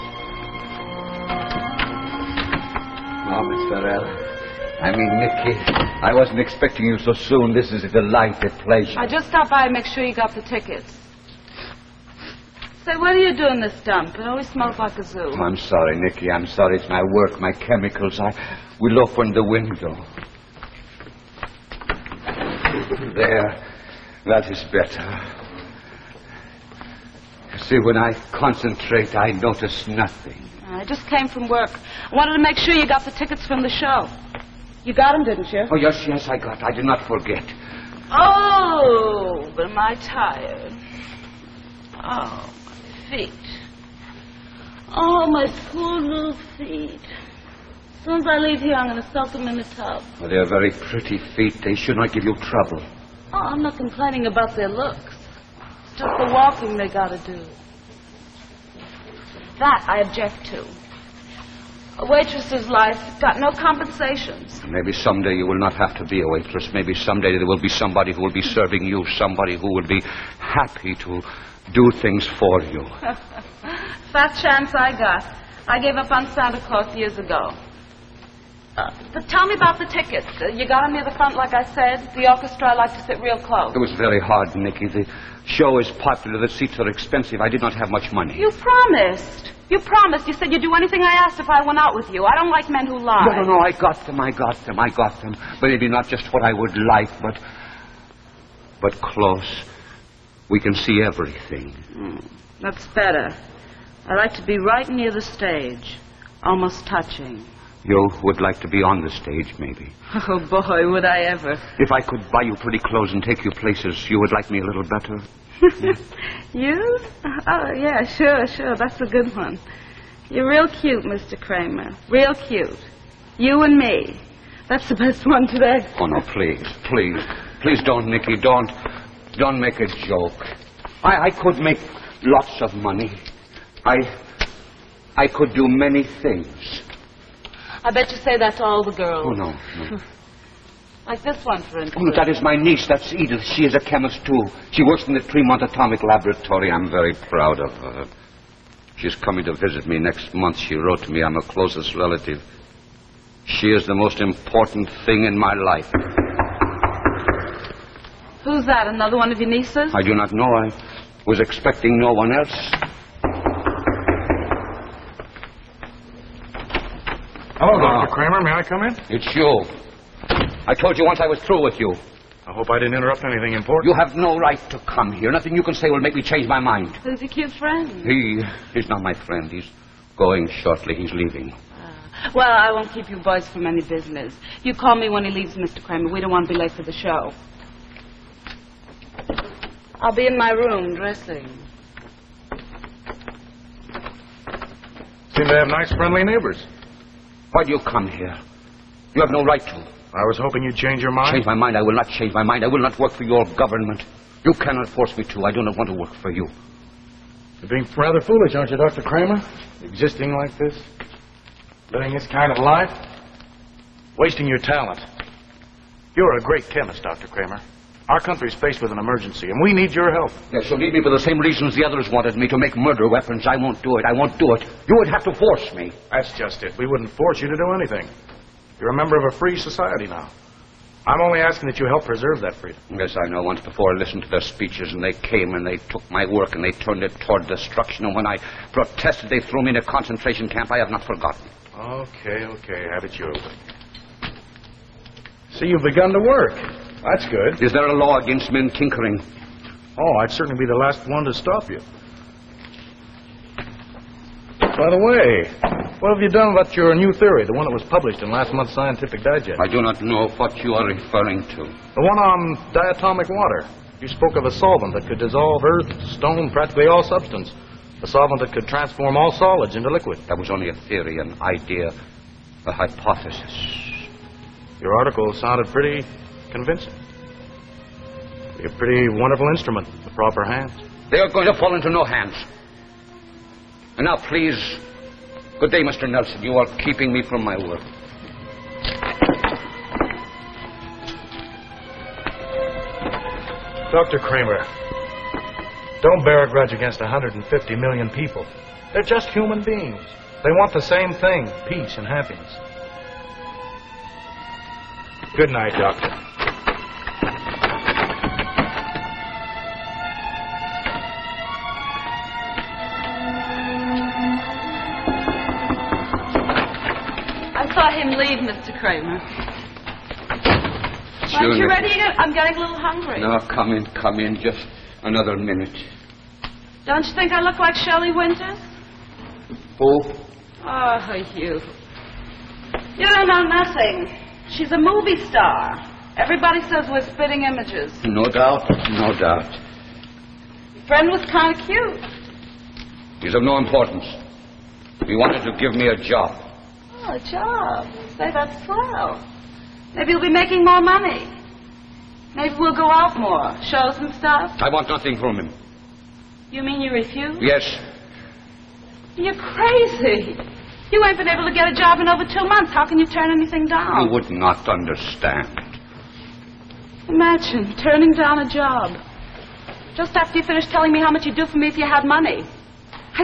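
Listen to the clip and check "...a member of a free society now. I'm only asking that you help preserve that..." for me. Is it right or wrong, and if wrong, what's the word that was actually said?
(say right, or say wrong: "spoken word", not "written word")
right.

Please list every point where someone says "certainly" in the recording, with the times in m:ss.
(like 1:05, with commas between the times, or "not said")
4:10.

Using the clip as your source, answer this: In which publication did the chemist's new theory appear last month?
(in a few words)
Scientific Digest.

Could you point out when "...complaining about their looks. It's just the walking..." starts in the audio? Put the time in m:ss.
0:53.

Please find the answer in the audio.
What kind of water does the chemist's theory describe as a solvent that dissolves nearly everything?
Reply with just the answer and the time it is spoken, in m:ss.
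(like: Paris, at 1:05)
Diatomic water, at 4:22.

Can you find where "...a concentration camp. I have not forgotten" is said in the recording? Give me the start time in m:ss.
3:59.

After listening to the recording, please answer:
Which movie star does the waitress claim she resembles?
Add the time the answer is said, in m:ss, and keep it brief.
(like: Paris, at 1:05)
Shelley Winters, at 5:27.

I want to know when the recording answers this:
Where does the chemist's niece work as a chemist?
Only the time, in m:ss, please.
2:25.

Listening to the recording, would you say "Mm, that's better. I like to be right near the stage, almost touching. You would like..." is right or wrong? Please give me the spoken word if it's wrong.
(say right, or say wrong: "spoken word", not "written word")
right.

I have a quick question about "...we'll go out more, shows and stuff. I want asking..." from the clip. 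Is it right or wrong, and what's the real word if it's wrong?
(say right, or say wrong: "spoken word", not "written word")
wrong: "nothing", not "asking".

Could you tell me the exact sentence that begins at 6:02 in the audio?
How can you turn anything down?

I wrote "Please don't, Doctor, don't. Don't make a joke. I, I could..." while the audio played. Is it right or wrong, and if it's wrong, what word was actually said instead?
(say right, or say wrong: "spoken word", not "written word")
wrong: "Nicky", not "Doctor".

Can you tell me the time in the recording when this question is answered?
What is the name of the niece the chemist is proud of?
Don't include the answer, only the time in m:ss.
2:23.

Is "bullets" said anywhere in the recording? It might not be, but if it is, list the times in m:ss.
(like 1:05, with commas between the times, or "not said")
not said.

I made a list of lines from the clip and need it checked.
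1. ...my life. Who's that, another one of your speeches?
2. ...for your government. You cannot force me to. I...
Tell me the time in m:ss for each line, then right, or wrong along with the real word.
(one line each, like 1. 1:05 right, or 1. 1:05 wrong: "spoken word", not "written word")
1. 2:35 wrong: "nieces", not "speeches"
2. 3:23 right.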